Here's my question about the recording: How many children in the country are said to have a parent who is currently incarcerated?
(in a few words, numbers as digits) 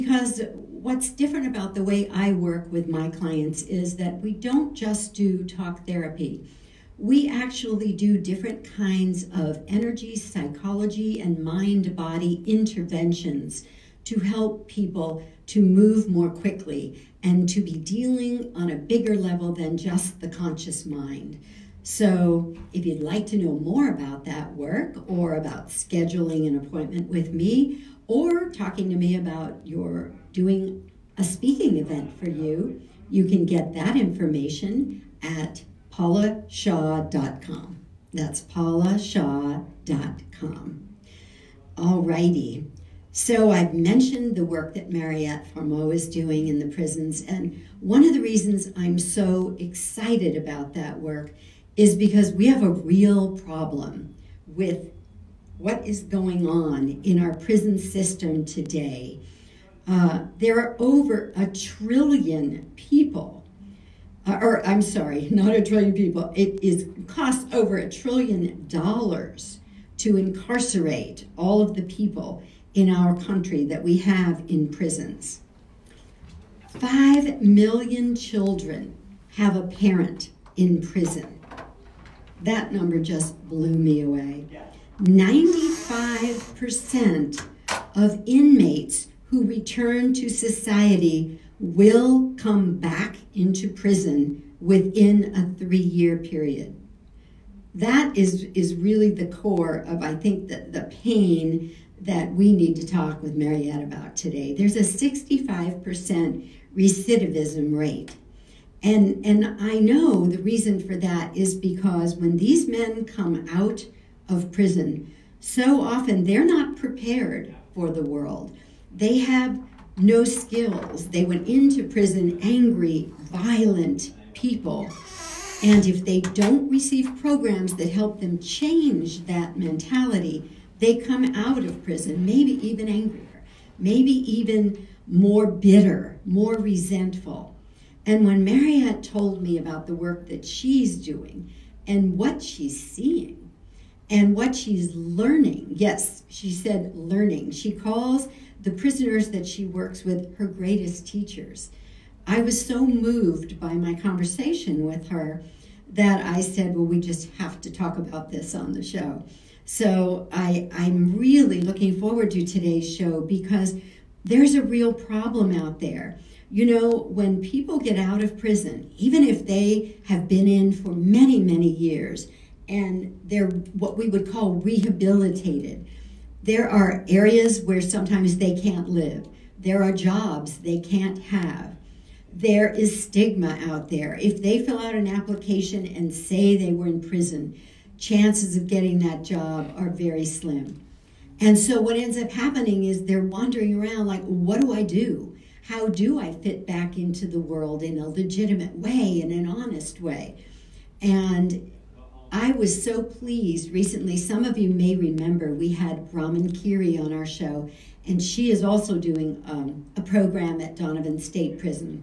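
5 million.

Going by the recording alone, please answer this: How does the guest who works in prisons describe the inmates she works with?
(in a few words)
her greatest teachers.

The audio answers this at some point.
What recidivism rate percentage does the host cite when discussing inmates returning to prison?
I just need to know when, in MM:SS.
01:44.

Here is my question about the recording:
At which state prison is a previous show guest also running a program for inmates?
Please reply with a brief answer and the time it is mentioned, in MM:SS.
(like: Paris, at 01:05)
Donovan State, at 03:30.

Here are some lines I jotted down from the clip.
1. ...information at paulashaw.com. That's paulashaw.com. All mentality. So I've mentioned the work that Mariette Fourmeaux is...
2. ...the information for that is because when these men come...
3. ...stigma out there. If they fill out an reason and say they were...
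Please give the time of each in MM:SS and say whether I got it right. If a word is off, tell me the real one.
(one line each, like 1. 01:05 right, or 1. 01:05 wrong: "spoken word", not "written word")
1. 00:33 wrong: "righty", not "mentality"
2. 01:50 wrong: "reason", not "information"
3. 03:03 wrong: "application", not "reason".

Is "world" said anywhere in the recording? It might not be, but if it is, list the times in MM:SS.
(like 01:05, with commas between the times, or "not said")
01:58, 03:17.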